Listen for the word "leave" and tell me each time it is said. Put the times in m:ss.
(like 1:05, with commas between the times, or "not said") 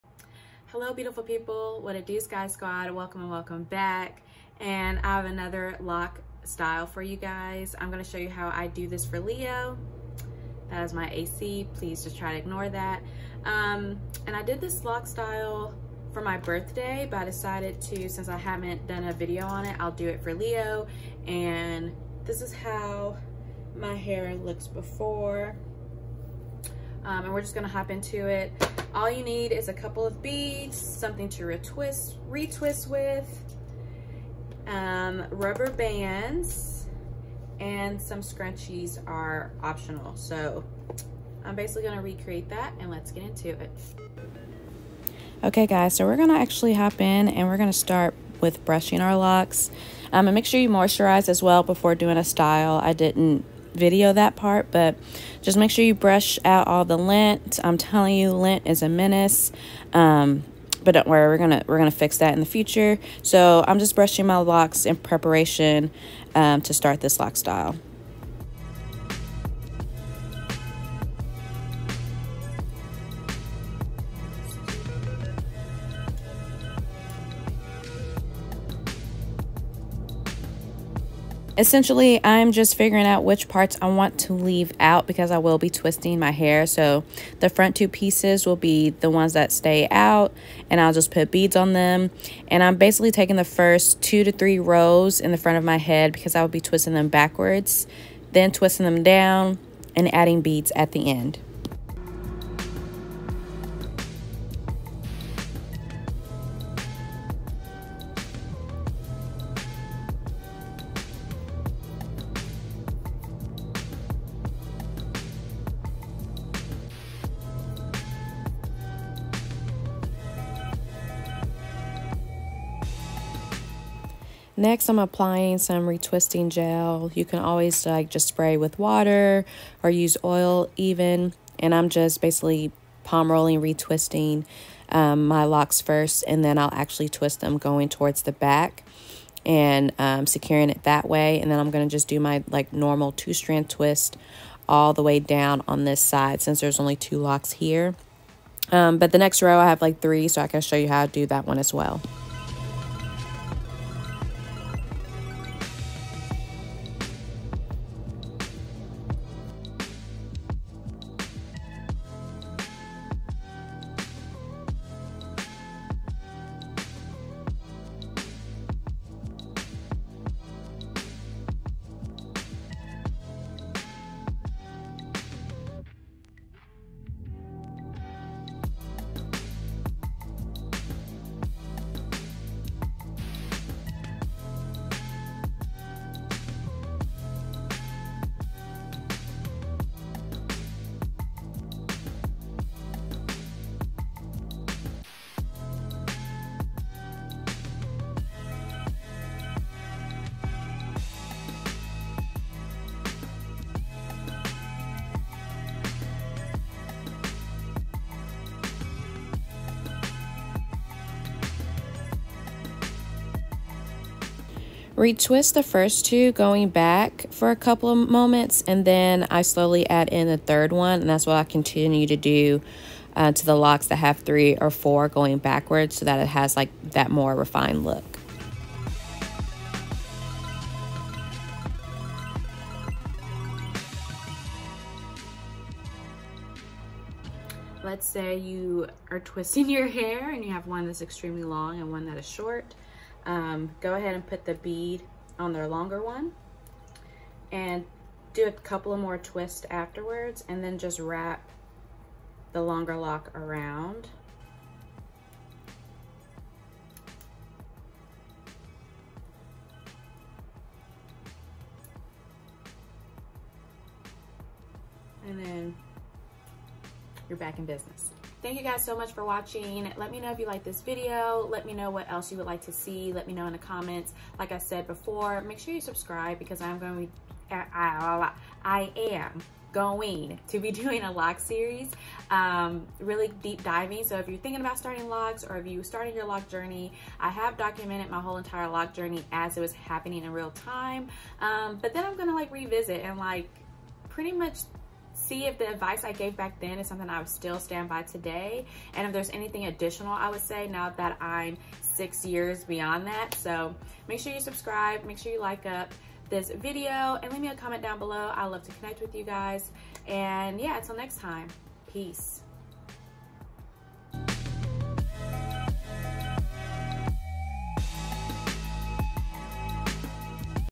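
1:24, 5:07.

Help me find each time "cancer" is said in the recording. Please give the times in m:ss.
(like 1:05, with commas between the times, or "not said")
not said.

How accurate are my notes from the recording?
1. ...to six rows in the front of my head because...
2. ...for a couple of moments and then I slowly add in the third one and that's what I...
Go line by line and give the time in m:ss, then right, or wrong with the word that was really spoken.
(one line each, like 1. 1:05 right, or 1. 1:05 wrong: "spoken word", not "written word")
1. 1:34 wrong: "three", not "six"
2. 3:37 right.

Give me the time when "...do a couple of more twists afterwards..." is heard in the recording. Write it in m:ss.
4:08.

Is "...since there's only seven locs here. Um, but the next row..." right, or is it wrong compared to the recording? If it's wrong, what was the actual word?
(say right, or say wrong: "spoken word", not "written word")
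wrong: "two", not "seven".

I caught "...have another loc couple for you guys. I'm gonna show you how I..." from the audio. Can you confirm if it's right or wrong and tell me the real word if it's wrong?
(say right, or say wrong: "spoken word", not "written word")
wrong: "style", not "couple".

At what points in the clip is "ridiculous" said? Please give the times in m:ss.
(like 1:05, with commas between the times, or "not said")
not said.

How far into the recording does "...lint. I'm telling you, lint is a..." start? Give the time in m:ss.
0:56.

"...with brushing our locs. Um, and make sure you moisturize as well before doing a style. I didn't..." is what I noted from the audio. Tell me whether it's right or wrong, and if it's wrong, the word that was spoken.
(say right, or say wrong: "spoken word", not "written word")
right.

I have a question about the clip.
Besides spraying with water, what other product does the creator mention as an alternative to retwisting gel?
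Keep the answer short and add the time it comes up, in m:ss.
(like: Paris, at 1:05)
oil, at 2:10.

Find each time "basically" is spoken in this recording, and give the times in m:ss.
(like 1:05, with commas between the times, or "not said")
0:41, 1:32, 2:12.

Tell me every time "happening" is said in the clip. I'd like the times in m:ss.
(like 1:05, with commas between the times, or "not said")
4:49.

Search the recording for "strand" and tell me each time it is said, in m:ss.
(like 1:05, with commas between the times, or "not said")
2:23.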